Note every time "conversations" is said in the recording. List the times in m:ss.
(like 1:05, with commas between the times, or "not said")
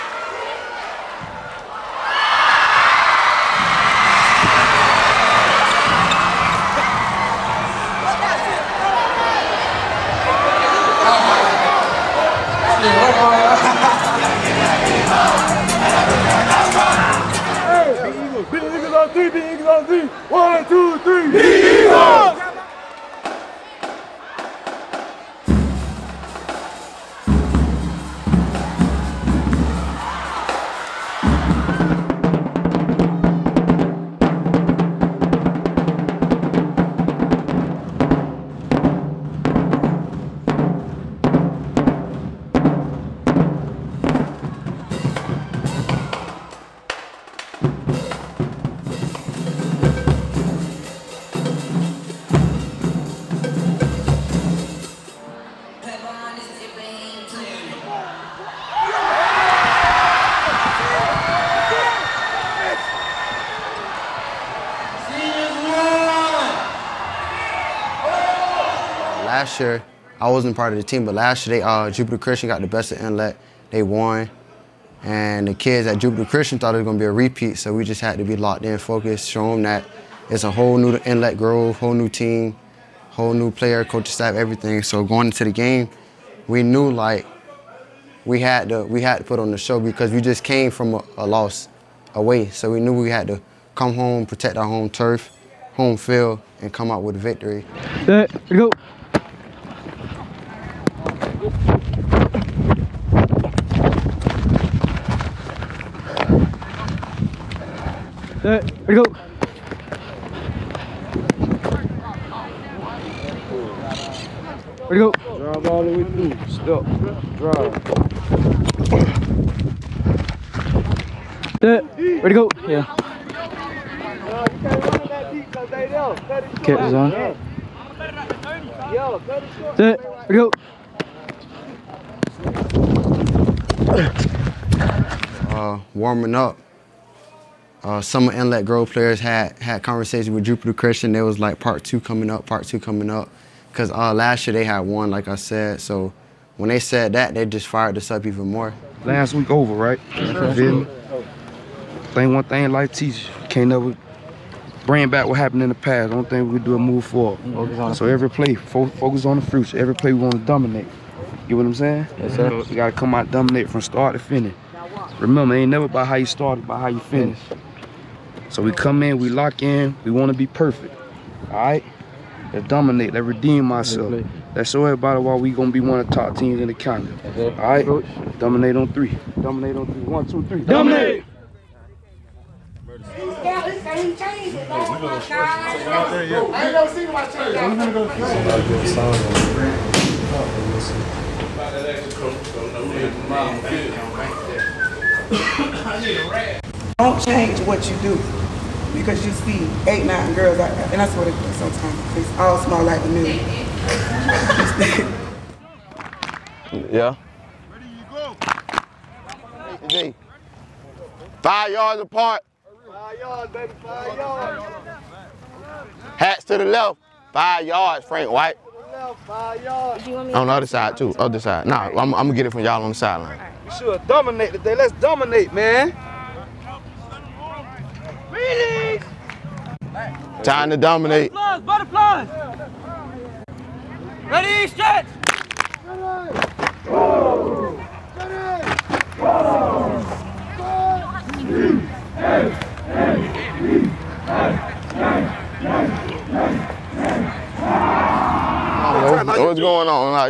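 2:19.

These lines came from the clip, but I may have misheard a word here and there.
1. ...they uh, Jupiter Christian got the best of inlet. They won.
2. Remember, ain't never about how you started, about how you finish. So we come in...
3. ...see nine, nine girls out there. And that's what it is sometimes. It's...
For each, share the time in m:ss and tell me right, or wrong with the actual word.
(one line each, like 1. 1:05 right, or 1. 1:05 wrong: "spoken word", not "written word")
1. 1:11 right
2. 2:45 right
3. 3:19 wrong: "eight", not "nine".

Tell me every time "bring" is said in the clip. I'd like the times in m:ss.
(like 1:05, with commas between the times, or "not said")
2:34.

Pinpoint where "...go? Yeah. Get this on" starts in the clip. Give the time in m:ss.
2:02.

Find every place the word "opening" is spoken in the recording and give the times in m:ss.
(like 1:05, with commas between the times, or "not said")
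not said.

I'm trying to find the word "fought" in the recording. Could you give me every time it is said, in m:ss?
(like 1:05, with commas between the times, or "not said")
not said.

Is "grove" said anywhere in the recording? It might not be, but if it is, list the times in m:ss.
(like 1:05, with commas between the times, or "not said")
1:21, 2:18.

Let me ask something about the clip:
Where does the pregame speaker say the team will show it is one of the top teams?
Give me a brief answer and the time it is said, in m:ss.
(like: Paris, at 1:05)
In the county, at 2:55.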